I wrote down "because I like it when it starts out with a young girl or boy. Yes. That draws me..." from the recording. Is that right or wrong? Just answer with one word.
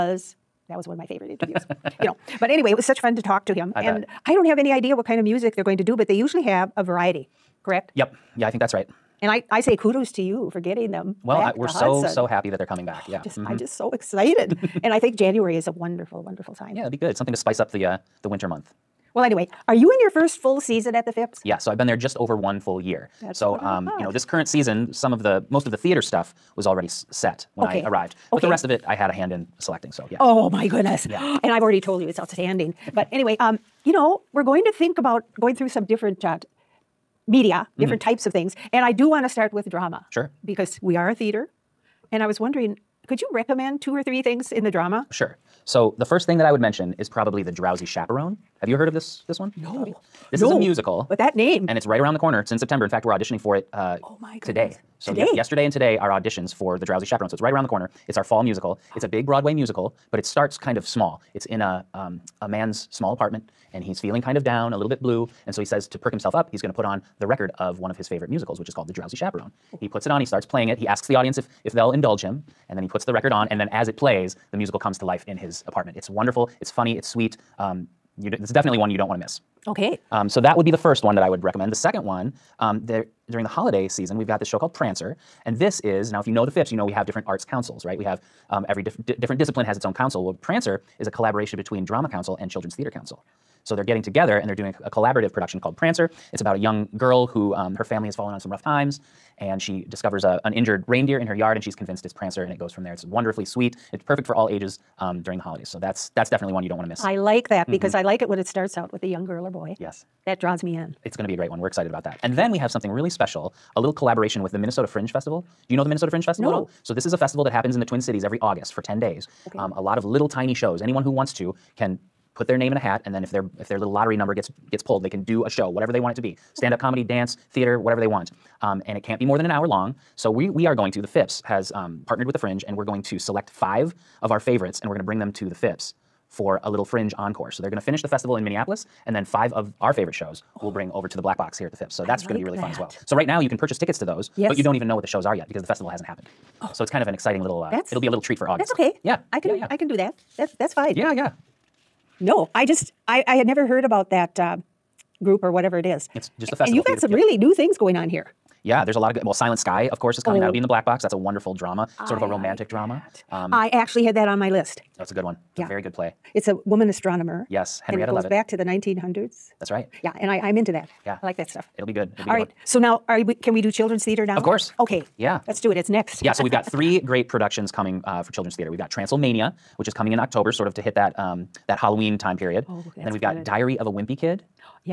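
right.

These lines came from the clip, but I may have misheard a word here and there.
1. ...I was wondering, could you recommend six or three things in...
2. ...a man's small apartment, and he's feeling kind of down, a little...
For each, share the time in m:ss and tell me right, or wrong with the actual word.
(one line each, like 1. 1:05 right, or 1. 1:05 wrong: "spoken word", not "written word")
1. 0:42 wrong: "two", not "six"
2. 1:02 right.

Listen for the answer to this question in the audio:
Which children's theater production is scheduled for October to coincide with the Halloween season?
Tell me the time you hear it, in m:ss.
2:58.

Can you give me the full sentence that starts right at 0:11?
Well, I, we're so so happy that they're coming back.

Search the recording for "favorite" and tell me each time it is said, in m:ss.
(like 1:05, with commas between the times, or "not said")
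0:01, 1:08, 2:14, 2:19.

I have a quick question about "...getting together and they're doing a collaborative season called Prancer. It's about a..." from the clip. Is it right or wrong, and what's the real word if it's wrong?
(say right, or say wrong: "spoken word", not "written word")
wrong: "production", not "season".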